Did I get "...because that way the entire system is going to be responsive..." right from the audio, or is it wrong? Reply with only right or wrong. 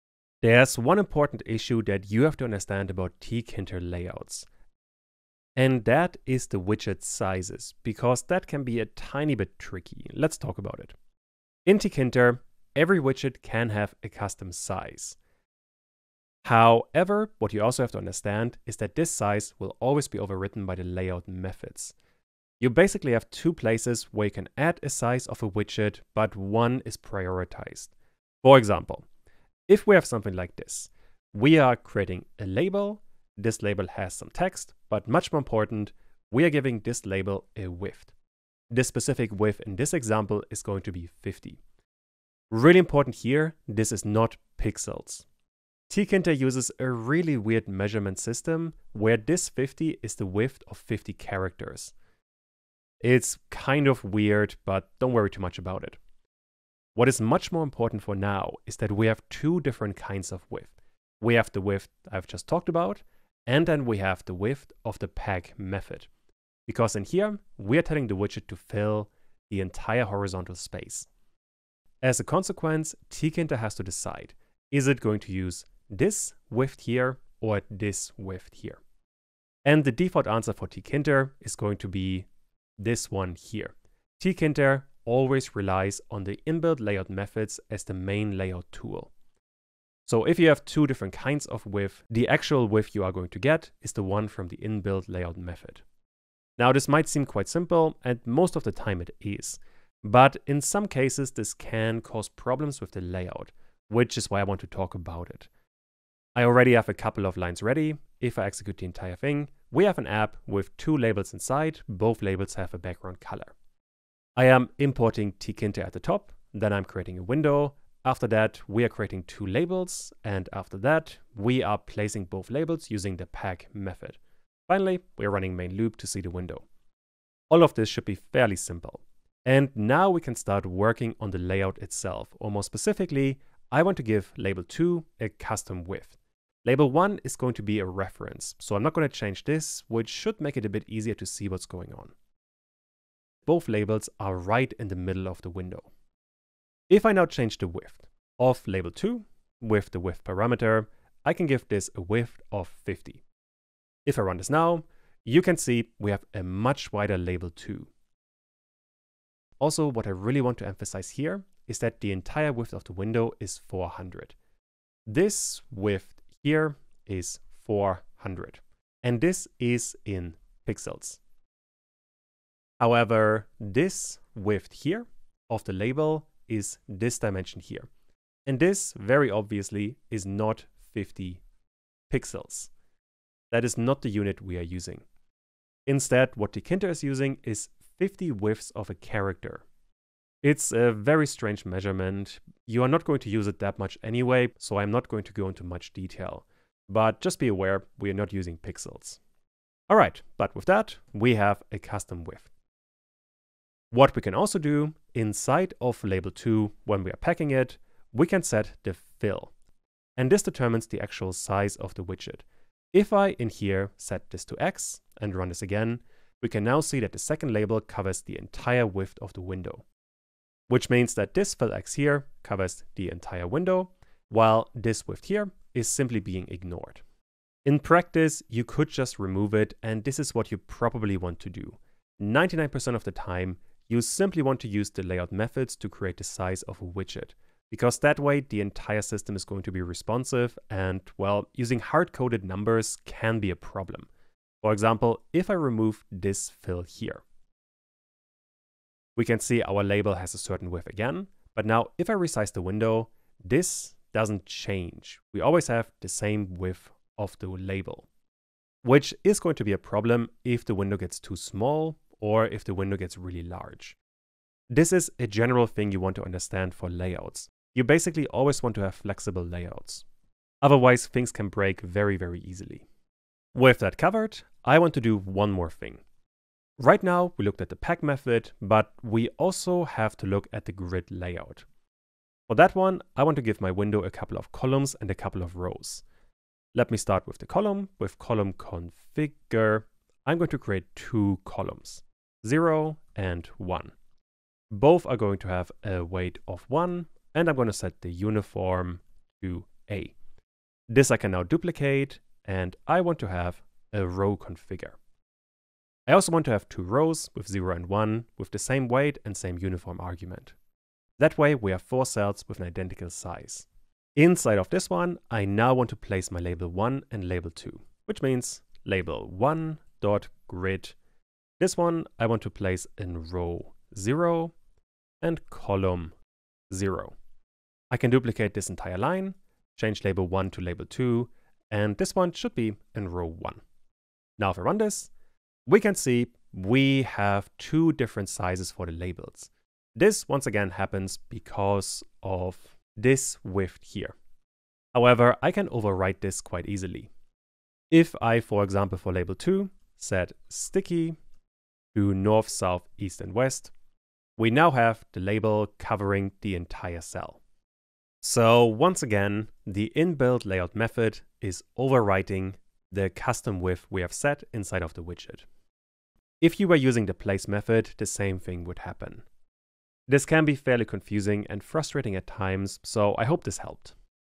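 right.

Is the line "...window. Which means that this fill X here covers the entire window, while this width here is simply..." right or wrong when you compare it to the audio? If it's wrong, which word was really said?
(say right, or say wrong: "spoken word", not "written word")
right.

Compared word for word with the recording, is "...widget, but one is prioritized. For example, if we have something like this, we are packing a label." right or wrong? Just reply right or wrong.
wrong.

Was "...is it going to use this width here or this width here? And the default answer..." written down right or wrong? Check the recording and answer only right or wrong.
right.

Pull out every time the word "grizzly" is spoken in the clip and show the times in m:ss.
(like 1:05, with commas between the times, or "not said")
not said.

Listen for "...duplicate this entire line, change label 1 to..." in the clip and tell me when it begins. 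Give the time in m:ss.
5:28.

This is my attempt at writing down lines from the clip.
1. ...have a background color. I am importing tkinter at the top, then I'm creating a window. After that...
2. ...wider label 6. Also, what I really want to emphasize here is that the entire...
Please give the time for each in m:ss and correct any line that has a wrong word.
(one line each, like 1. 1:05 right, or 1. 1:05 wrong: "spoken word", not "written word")
1. 1:52 right
2. 2:36 wrong: "2", not "6".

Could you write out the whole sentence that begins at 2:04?
Finally, we're running main loop to see the window.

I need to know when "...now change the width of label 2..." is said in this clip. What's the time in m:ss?
2:27.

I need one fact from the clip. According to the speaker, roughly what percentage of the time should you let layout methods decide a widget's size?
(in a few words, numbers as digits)
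99%.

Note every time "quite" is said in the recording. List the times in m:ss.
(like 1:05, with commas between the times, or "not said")
1:37, 5:46.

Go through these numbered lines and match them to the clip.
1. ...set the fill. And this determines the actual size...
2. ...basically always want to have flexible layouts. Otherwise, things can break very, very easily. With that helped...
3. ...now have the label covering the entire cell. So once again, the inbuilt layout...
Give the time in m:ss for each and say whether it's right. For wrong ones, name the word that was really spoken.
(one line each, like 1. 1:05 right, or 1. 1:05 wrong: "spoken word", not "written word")
1. 3:28 right
2. 4:27 wrong: "covered", not "helped"
3. 5:54 right.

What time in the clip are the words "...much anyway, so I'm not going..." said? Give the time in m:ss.
3:13.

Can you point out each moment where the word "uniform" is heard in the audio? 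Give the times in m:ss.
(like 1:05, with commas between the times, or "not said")
4:58, 5:09.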